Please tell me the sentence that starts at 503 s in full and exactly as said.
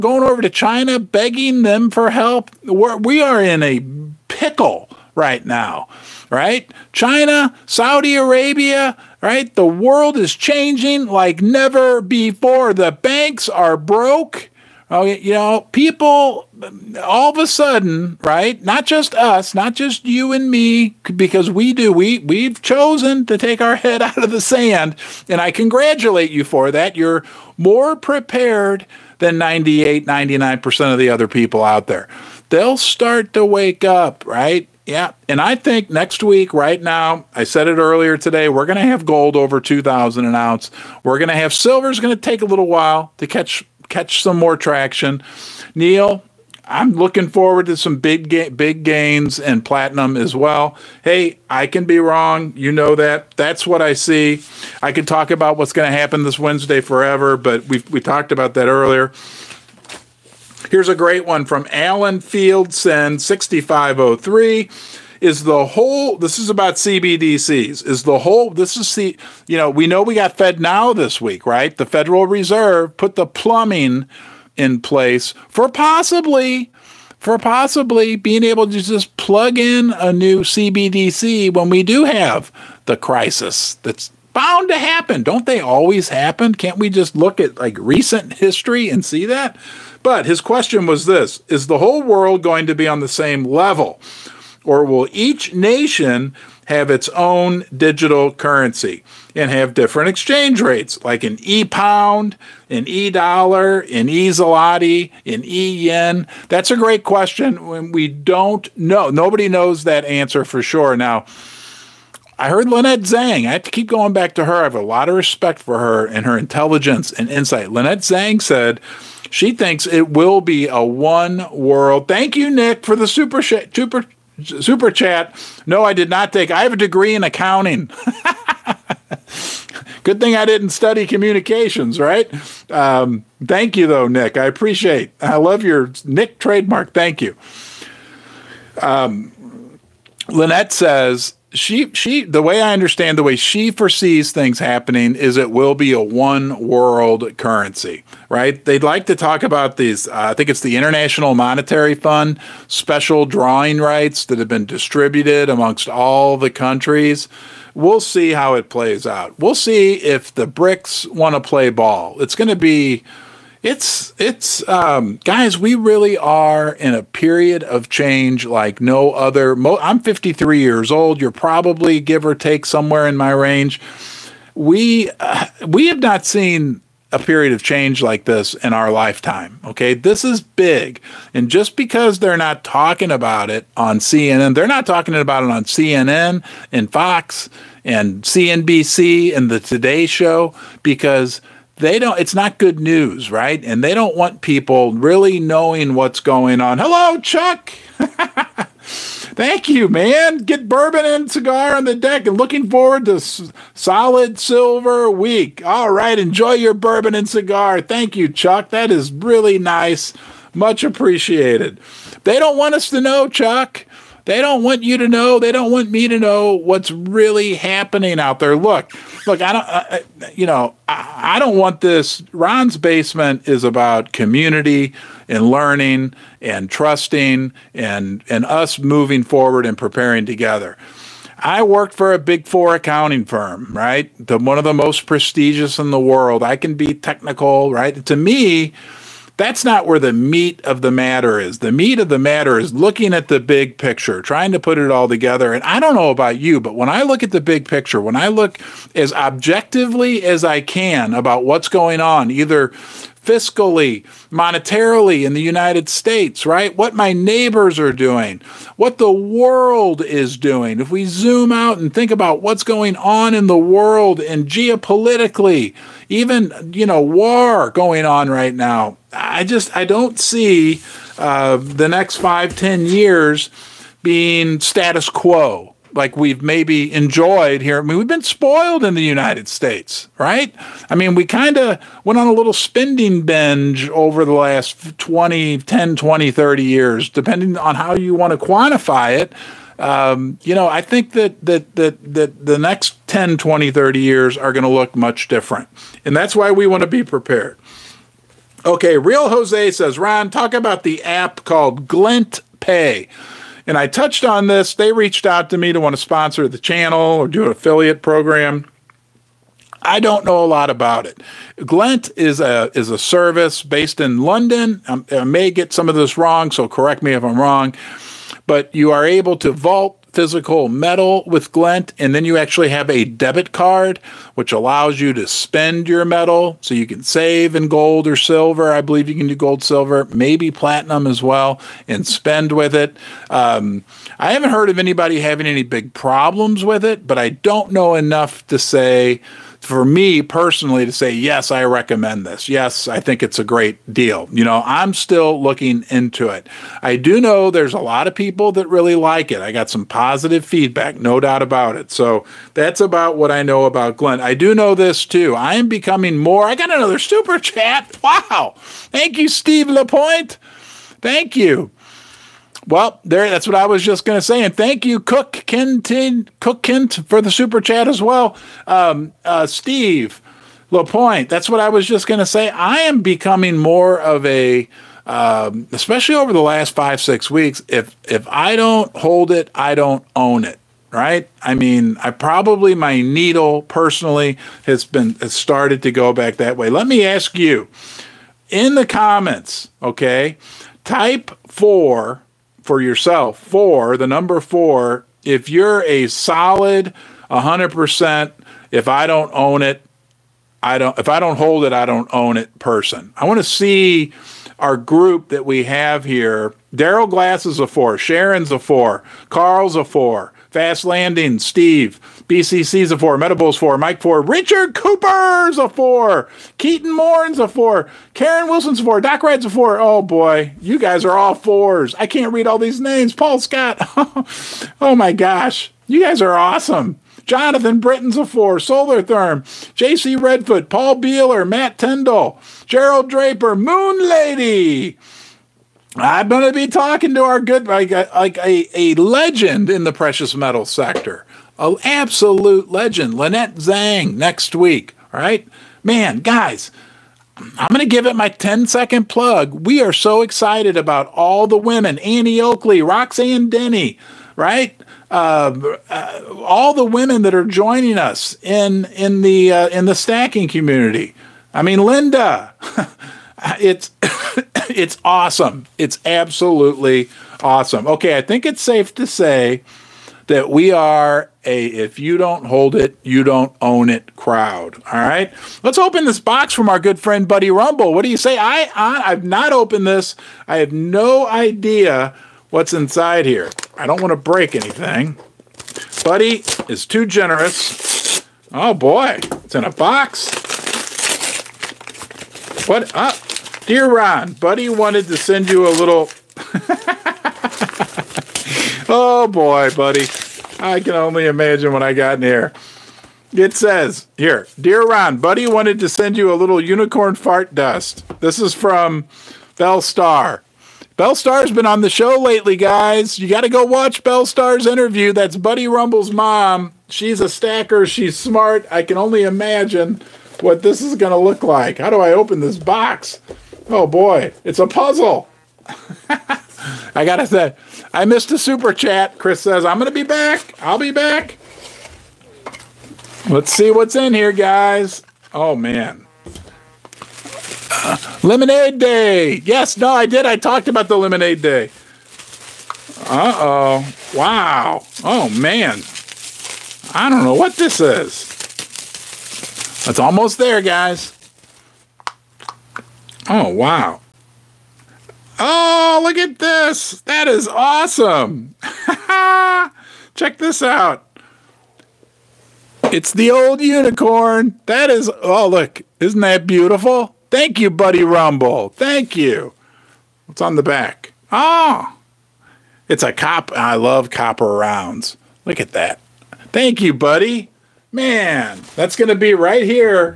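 It says here, dear Ron, buddy wanted to send you a little unicorn fart dust.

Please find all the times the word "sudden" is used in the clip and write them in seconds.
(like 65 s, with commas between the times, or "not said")
17 s.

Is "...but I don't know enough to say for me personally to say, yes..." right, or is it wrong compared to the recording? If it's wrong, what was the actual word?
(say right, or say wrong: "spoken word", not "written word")
right.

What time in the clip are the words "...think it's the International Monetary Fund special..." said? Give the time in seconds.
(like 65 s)
150 s.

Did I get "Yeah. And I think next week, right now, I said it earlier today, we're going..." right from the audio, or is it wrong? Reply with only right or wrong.
right.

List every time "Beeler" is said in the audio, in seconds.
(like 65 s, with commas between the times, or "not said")
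430 s.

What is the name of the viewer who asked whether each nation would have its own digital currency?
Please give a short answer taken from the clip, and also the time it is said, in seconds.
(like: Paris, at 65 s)
Alan Fieldson, at 61 s.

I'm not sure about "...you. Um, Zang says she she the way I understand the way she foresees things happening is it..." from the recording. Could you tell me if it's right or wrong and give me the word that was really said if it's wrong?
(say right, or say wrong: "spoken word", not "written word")
wrong: "Lynette", not "Zang".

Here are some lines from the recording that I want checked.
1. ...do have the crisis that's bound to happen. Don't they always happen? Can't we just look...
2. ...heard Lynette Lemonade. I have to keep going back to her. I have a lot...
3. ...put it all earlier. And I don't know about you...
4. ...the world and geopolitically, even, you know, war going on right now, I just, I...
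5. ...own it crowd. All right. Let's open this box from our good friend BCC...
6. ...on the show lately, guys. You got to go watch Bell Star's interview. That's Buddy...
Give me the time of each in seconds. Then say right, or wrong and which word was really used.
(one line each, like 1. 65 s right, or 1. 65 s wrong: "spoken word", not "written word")
1. 81 s right
2. 112 s wrong: "Zang", not "Lemonade"
3. 244 s wrong: "together", not "earlier"
4. 263 s right
5. 473 s wrong: "Buddy", not "BCC"
6. 511 s right.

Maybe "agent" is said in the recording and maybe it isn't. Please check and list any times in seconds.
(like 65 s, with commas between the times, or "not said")
not said.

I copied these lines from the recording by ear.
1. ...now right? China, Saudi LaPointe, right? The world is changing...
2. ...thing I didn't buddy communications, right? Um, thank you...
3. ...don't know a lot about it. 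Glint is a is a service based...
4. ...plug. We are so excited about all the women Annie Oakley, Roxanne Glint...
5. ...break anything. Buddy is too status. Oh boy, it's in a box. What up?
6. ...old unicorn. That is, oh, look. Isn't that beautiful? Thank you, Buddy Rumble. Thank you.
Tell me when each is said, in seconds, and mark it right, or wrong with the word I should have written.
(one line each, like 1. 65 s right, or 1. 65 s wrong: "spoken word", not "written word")
1. 5 s wrong: "Arabia", not "LaPointe"
2. 130 s wrong: "study", not "buddy"
3. 309 s right
4. 449 s wrong: "Denny", not "Glint"
5. 484 s wrong: "generous", not "status"
6. 563 s right.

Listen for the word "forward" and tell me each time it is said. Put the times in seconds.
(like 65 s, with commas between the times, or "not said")
47 s, 202 s, 229 s.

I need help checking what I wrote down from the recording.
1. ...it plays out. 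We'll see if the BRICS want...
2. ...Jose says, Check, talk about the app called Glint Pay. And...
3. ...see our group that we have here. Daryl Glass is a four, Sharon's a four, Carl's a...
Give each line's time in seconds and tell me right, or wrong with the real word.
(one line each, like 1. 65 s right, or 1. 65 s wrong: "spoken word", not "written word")
1. 158 s right
2. 299 s wrong: "Ron", not "Check"
3. 403 s right.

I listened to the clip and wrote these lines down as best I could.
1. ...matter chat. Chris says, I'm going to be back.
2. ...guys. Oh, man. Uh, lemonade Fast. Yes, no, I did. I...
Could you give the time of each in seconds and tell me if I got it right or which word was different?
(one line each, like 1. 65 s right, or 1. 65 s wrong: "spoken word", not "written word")
1. 528 s wrong: "super", not "matter"
2. 534 s wrong: "Day", not "Fast".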